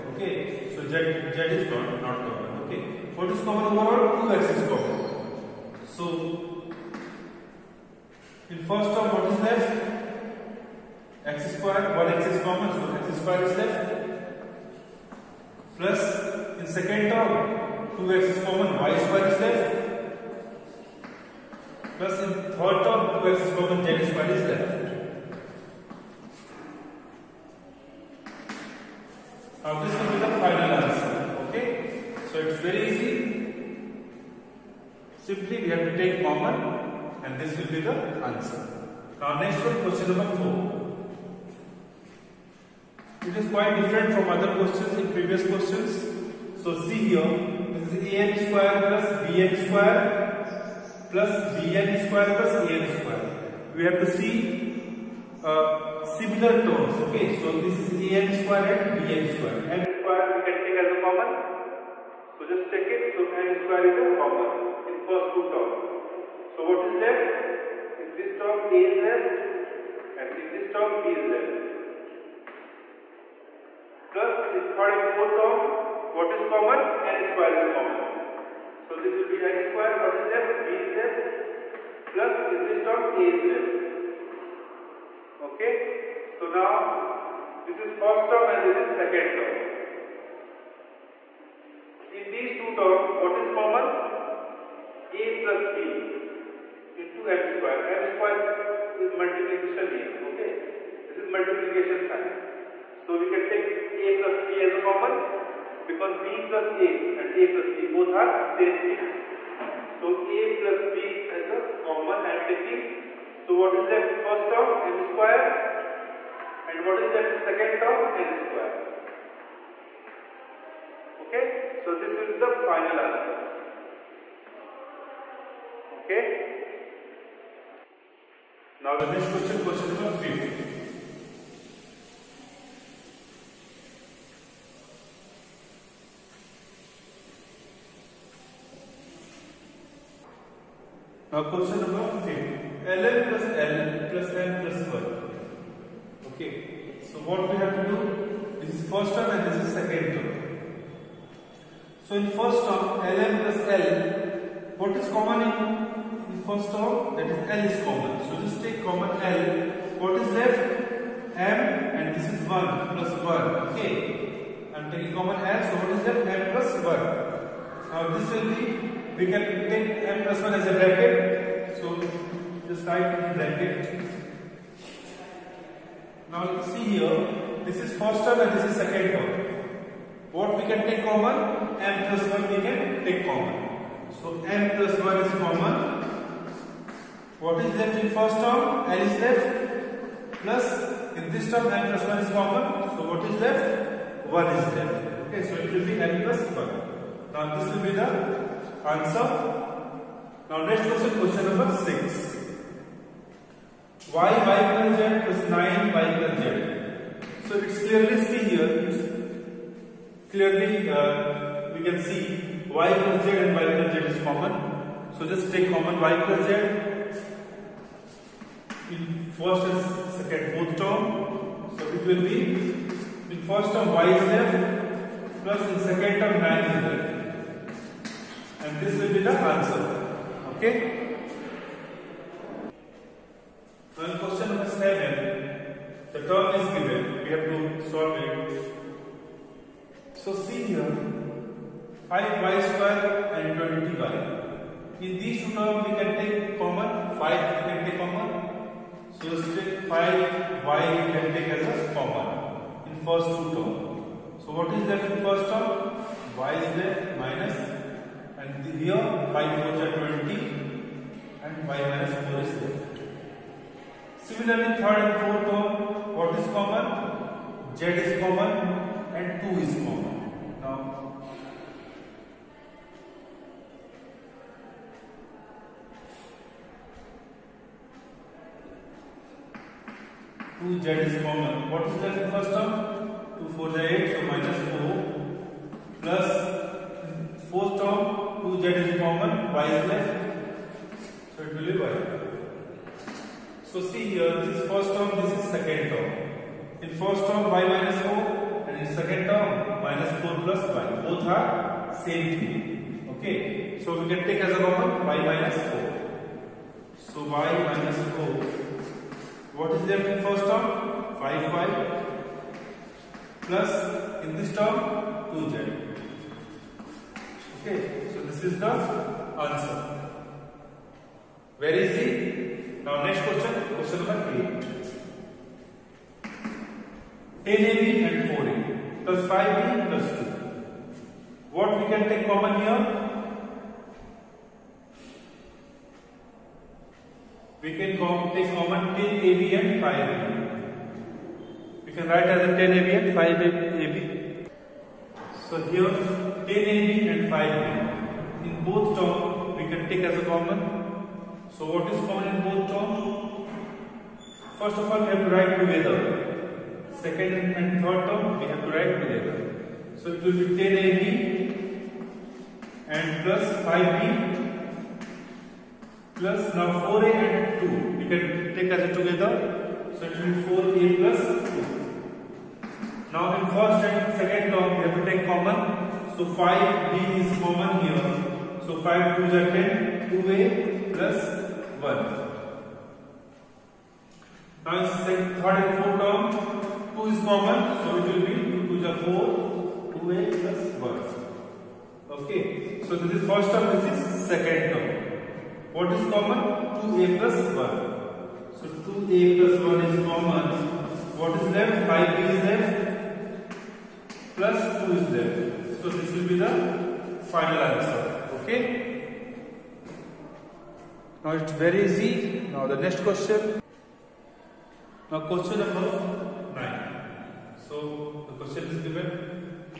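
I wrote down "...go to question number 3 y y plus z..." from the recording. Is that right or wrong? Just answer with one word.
wrong.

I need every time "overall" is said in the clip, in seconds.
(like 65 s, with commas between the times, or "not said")
3 s.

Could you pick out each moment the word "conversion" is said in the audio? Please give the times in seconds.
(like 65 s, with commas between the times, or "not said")
not said.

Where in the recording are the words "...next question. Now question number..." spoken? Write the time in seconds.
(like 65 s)
412 s.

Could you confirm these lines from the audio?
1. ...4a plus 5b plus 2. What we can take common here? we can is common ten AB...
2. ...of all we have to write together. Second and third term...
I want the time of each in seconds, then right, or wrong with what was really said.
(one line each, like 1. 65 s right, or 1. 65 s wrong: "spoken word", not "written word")
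1. 328 s right
2. 354 s right.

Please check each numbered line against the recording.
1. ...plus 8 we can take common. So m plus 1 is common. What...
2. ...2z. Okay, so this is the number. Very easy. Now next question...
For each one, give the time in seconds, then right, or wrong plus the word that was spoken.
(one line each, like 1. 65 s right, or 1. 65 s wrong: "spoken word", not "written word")
1. 182 s wrong: "1", not "8"
2. 315 s wrong: "answer", not "number".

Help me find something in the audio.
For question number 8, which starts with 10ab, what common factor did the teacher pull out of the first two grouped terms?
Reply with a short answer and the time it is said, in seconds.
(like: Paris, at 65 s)
5b, at 376 s.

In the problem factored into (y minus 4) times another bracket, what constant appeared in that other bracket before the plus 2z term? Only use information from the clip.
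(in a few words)
5.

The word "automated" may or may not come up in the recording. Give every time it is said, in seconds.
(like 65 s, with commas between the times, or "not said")
not said.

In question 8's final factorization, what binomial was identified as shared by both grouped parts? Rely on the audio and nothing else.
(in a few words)
2a plus 1.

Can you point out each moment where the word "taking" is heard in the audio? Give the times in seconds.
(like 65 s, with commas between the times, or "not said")
112 s, 164 s.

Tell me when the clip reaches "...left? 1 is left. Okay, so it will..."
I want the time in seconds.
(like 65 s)
193 s.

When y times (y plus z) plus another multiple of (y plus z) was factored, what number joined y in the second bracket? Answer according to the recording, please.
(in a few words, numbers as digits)
9.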